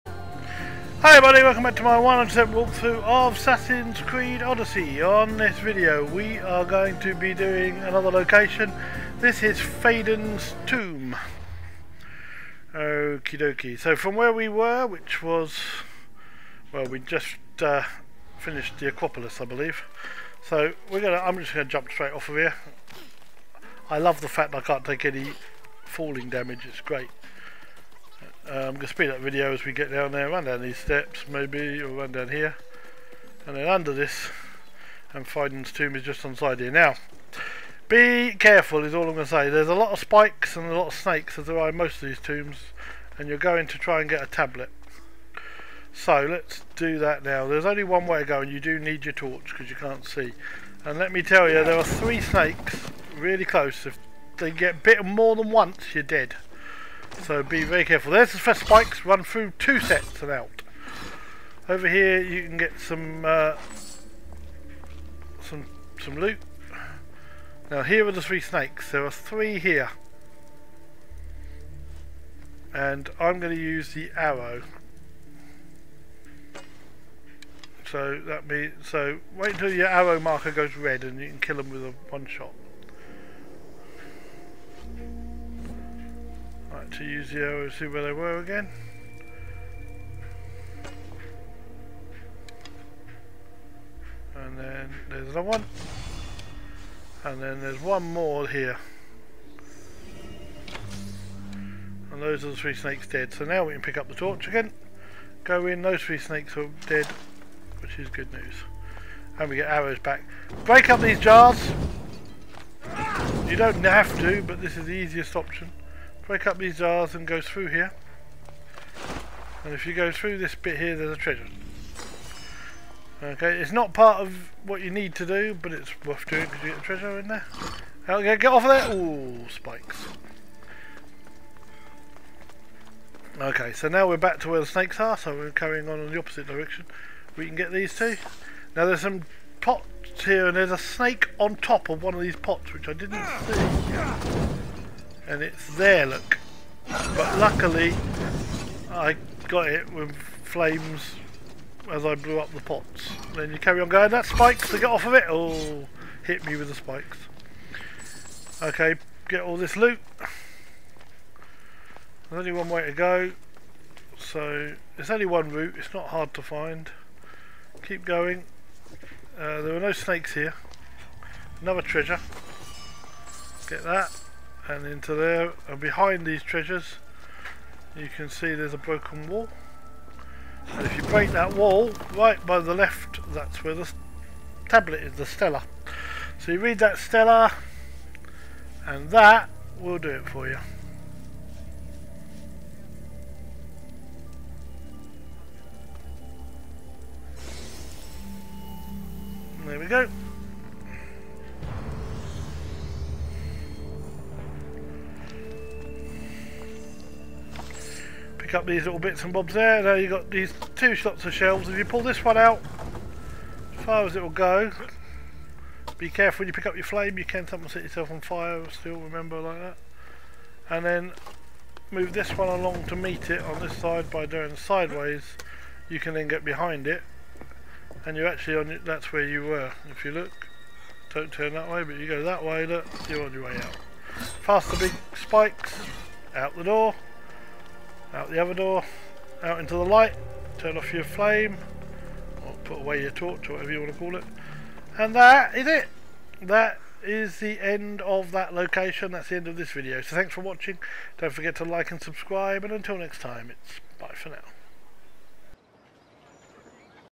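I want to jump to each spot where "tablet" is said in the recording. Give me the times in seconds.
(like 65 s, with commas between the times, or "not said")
44 s, 184 s.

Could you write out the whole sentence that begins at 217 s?
You can sometimes set yourself on fire still, remember, like that.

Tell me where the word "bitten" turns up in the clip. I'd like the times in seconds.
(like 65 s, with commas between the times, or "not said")
54 s.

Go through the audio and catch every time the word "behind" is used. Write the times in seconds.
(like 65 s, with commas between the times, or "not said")
175 s, 226 s.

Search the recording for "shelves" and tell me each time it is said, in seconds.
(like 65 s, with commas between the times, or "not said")
211 s.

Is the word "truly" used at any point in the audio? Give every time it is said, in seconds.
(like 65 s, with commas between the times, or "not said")
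not said.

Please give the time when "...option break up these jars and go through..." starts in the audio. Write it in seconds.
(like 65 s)
115 s.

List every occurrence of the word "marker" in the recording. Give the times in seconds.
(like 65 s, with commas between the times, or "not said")
80 s.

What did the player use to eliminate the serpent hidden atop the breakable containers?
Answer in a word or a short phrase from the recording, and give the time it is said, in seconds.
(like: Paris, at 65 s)
flames, at 150 s.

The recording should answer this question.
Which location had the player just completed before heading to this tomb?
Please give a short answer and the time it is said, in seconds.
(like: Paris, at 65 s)
the Acropolis, at 18 s.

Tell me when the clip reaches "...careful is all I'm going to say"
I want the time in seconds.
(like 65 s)
38 s.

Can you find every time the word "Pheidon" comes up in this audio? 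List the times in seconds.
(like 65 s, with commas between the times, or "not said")
9 s, 35 s.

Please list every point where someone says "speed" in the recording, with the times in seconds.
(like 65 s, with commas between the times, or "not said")
28 s.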